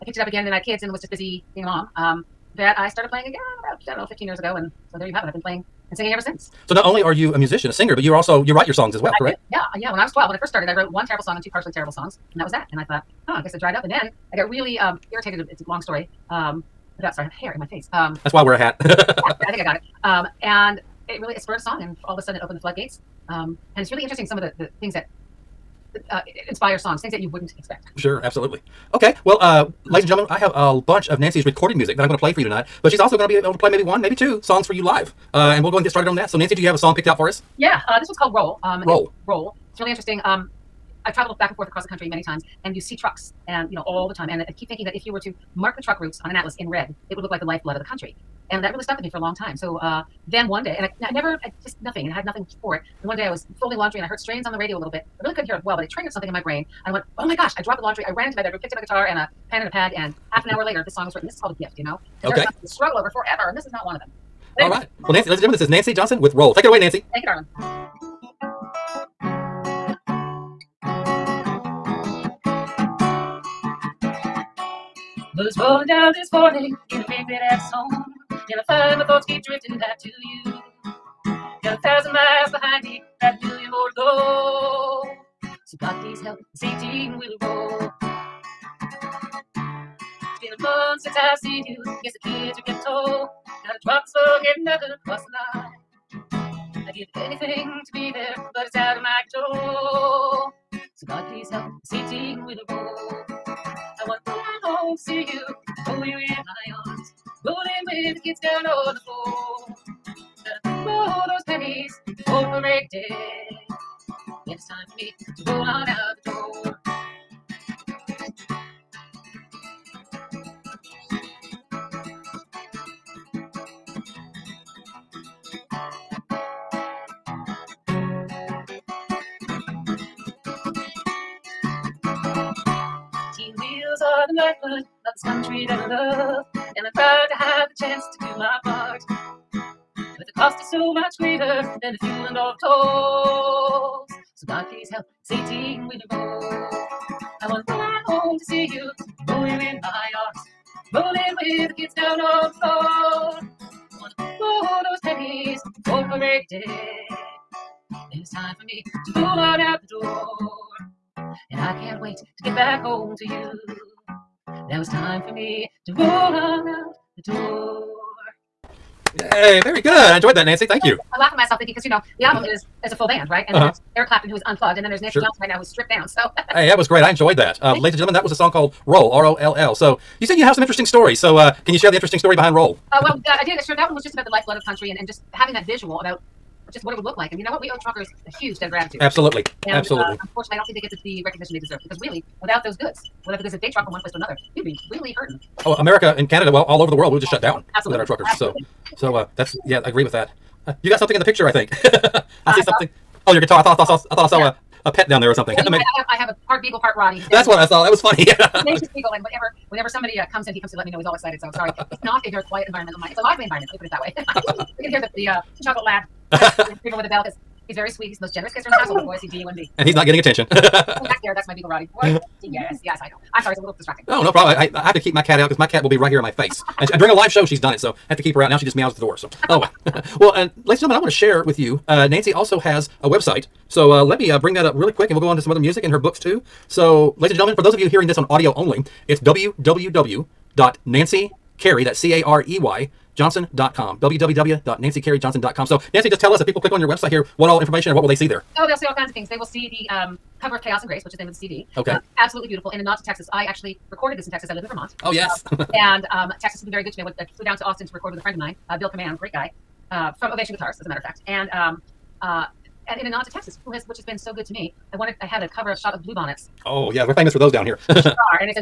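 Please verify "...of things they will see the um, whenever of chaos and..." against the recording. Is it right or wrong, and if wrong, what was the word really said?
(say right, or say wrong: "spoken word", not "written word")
wrong: "cover", not "whenever".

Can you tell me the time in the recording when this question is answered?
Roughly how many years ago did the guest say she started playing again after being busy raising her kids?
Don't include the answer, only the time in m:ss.
0:04.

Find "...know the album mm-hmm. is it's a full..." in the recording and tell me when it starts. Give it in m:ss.
2:51.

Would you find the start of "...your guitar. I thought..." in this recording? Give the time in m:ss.
3:23.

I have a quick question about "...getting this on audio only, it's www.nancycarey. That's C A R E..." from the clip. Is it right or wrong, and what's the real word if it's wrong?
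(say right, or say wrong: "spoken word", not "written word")
wrong: "hearing", not "getting".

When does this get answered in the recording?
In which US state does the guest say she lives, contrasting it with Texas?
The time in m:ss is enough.
4:14.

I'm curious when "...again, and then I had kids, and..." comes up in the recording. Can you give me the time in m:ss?
0:00.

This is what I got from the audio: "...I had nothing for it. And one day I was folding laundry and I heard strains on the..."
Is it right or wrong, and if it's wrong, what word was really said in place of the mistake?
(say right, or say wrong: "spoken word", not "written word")
right.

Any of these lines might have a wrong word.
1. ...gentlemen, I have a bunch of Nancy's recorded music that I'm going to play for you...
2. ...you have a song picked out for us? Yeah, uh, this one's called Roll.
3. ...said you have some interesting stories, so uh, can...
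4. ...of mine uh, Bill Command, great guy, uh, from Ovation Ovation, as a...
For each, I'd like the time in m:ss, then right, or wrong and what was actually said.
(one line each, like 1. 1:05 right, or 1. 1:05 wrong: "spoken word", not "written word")
1. 0:30 right
2. 0:36 right
3. 3:00 right
4. 4:18 wrong: "Guitars", not "Ovation".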